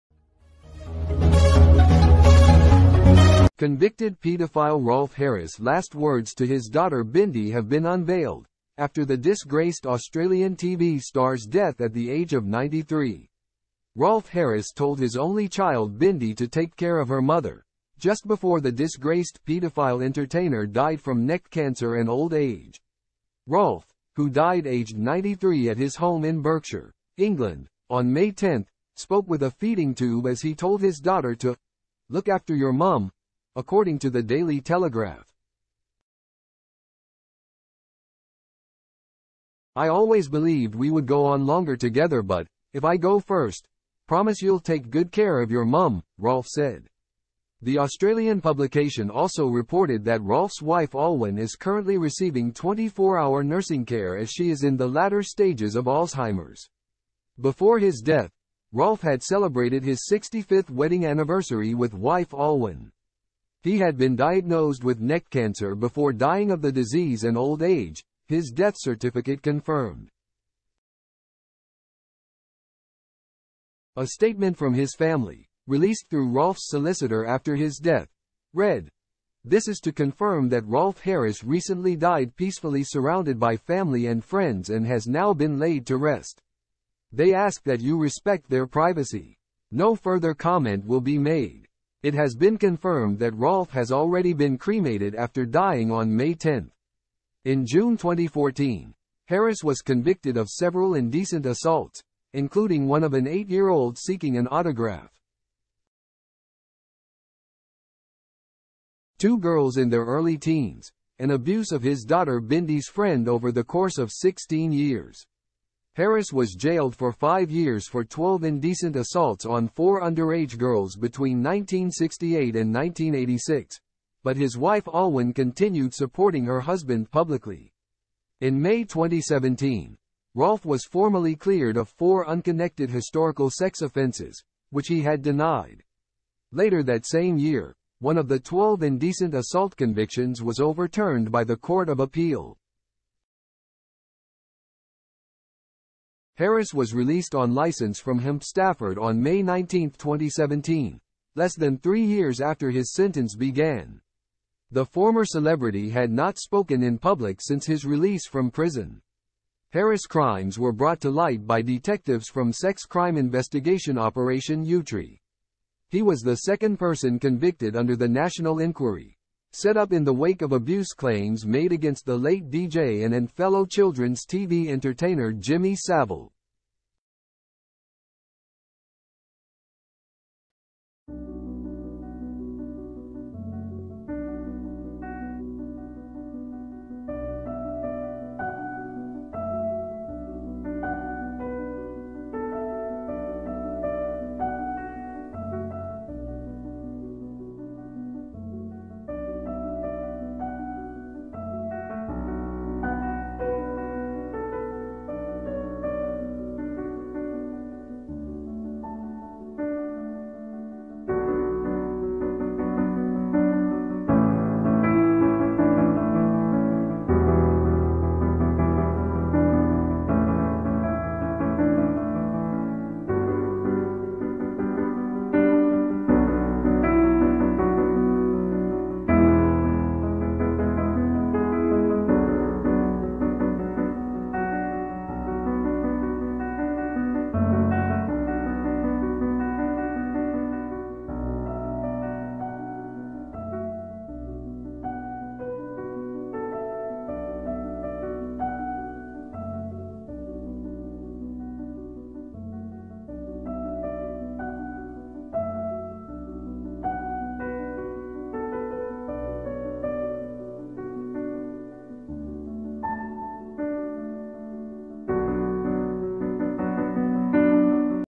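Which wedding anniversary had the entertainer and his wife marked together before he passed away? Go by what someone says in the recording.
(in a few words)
65th.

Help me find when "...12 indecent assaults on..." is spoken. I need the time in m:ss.
1:58.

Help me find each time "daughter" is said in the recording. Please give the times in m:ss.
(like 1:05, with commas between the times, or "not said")
0:06, 0:30, 1:52.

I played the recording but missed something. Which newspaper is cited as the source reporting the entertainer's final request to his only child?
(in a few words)
Daily Telegraph.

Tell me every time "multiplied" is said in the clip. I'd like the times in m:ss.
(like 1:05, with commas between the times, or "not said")
not said.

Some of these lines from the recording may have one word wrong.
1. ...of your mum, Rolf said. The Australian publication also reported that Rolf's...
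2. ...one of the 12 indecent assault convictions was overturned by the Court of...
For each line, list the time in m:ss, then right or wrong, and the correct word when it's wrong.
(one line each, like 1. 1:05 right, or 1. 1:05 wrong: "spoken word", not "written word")
1. 0:45 right
2. 2:17 right.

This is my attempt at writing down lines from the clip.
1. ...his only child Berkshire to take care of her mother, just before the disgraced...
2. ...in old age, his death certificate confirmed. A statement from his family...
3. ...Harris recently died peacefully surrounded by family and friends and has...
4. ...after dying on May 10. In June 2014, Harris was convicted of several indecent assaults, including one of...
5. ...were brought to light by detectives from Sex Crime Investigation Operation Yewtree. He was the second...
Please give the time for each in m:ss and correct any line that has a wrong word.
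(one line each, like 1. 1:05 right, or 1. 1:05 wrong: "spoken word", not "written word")
1. 0:14 wrong: "Bindi", not "Berkshire"
2. 1:07 right
3. 1:21 right
4. 1:35 right
5. 2:40 right.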